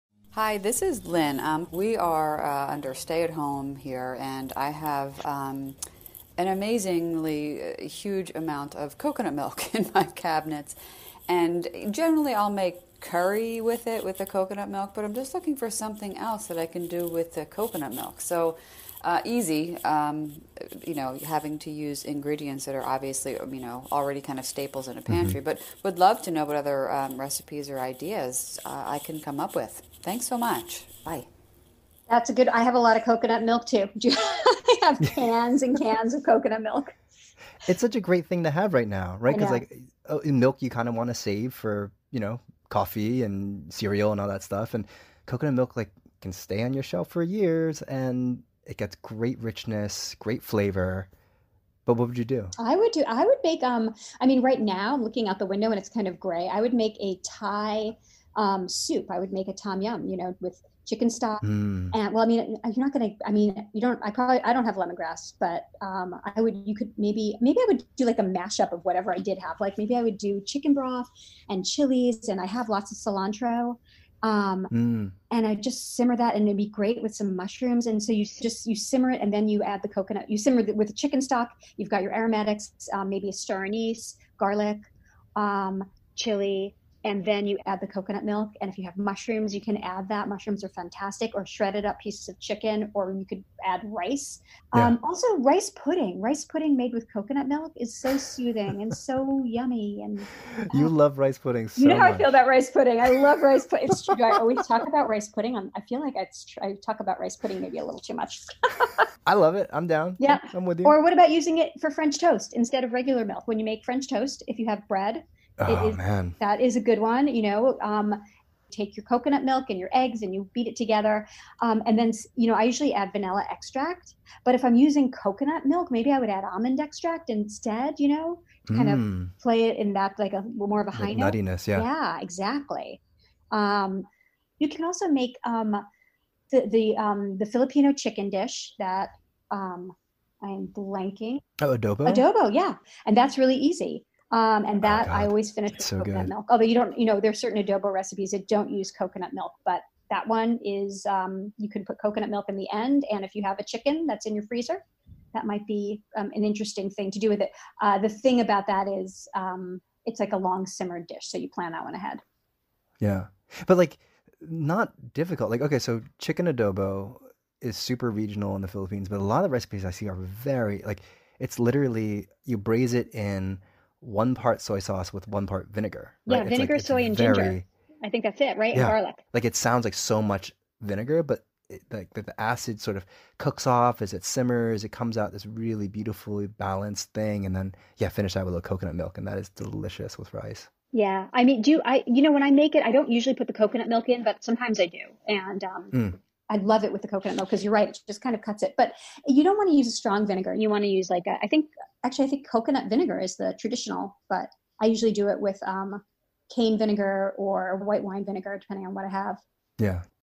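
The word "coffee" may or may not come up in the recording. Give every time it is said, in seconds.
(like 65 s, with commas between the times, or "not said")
42 s.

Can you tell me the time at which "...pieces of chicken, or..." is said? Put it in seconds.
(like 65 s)
91 s.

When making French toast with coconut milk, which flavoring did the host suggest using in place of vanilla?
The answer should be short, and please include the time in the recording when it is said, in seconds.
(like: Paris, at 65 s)
Almond extract, at 126 s.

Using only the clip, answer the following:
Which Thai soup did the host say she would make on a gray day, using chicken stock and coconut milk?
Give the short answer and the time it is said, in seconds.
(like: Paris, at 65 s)
Tom yum, at 59 s.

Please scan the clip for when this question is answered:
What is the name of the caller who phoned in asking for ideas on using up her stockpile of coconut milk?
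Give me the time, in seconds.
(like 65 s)
1 s.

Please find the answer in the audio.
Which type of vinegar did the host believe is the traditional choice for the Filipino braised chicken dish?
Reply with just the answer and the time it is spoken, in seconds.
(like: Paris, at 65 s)
Coconut vinegar, at 202 s.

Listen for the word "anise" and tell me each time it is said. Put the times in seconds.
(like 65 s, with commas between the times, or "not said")
83 s.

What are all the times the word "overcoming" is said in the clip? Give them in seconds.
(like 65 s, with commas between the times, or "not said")
not said.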